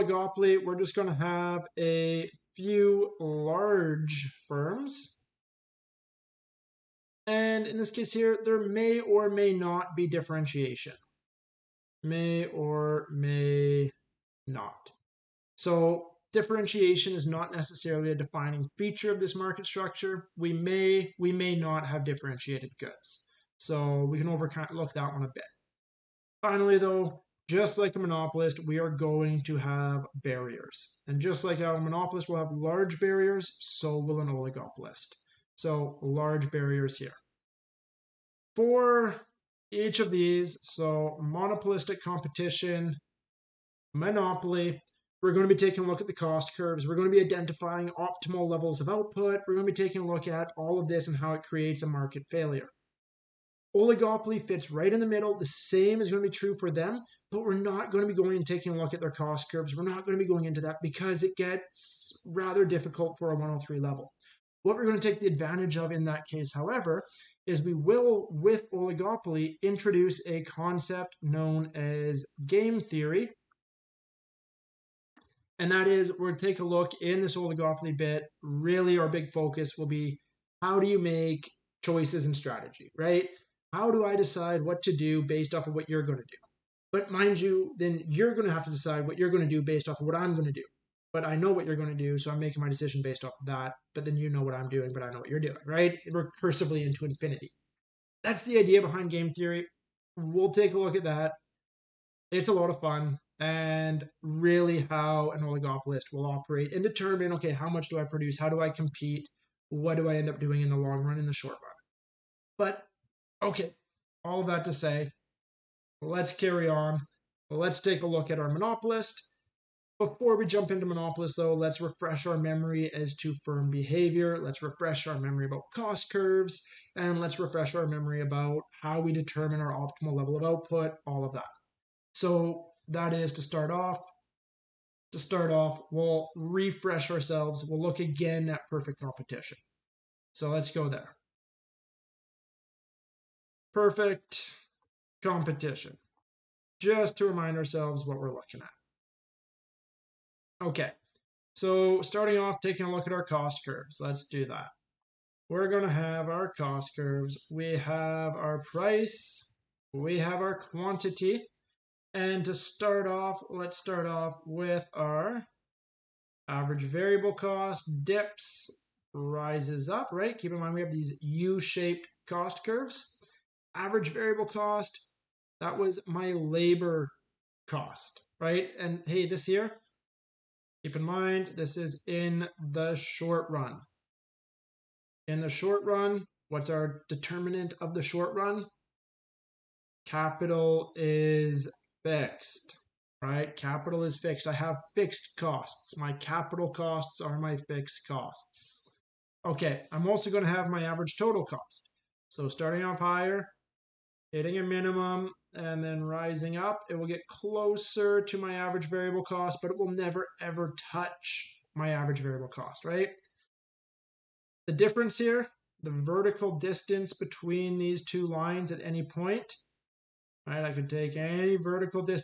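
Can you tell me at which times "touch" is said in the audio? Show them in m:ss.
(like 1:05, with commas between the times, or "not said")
3:30.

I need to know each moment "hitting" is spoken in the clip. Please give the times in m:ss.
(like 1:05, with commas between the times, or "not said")
3:24.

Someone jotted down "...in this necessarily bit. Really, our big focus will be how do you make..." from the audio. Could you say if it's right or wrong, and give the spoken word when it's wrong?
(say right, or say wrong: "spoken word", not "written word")
wrong: "oligopoly", not "necessarily".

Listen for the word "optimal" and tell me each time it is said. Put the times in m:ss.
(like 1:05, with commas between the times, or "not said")
0:47, 2:09.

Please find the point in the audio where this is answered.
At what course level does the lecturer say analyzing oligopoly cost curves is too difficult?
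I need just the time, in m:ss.
1:03.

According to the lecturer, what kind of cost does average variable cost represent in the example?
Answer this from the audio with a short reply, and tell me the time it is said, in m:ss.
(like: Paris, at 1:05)
labor cost, at 2:56.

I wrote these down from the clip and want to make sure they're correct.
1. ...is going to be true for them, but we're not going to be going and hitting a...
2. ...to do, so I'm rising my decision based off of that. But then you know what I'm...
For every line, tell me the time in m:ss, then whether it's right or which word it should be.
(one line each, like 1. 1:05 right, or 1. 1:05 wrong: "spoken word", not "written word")
1. 0:55 wrong: "taking", not "hitting"
2. 1:31 wrong: "making", not "rising".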